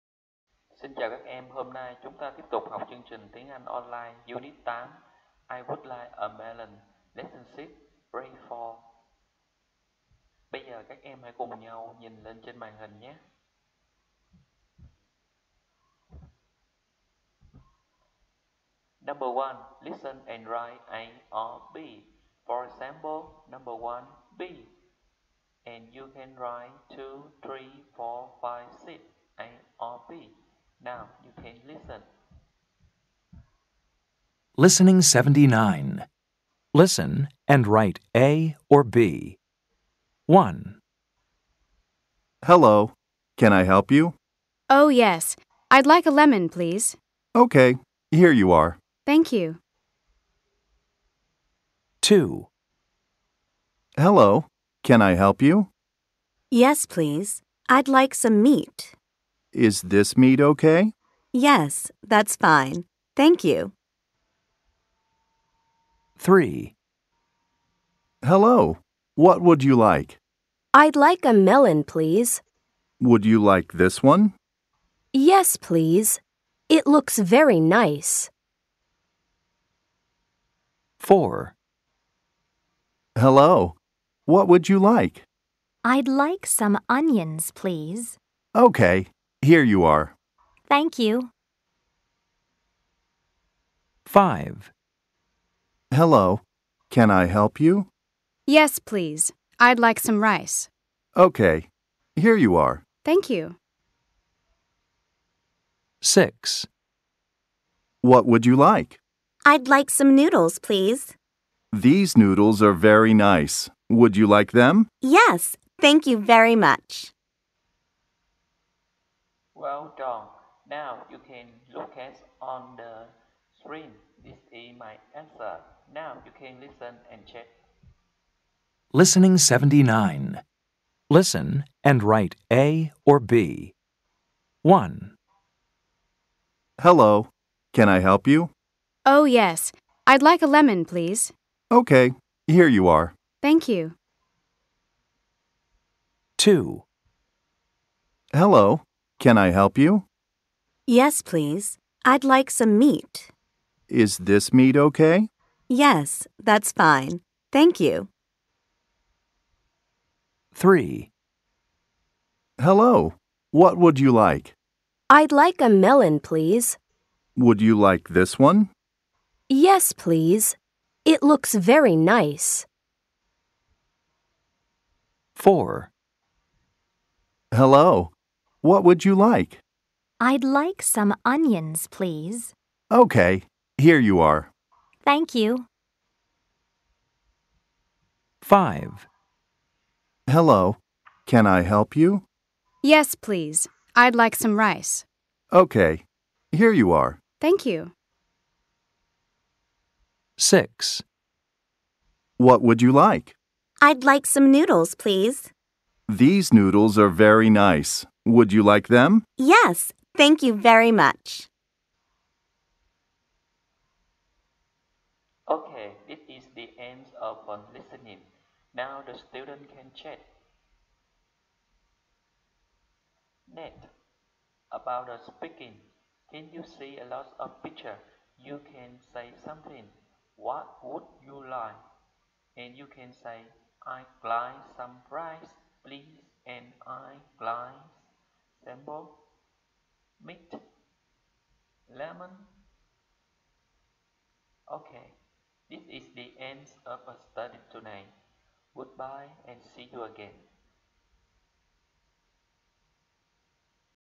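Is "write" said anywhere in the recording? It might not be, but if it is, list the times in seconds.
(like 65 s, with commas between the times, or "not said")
20 s, 26 s, 37 s, 132 s.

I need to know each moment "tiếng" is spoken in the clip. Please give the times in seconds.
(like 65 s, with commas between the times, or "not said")
3 s.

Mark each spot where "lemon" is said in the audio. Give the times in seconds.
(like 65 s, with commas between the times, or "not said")
46 s, 140 s, 241 s.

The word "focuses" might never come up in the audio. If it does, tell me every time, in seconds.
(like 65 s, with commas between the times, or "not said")
not said.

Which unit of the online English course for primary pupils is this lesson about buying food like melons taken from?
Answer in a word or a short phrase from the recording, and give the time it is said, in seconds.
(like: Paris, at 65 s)
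Unit 8, at 4 s.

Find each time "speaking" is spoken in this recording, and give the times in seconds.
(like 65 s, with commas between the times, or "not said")
225 s.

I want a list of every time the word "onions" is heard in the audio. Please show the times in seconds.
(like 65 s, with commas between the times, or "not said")
86 s, 181 s.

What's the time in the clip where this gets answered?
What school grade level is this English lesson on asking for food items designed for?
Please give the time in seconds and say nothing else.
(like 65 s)
8 s.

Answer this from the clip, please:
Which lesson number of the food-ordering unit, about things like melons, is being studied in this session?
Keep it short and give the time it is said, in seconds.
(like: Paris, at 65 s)
Lesson 6, at 7 s.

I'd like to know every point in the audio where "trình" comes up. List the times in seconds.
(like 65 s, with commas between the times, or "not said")
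3 s.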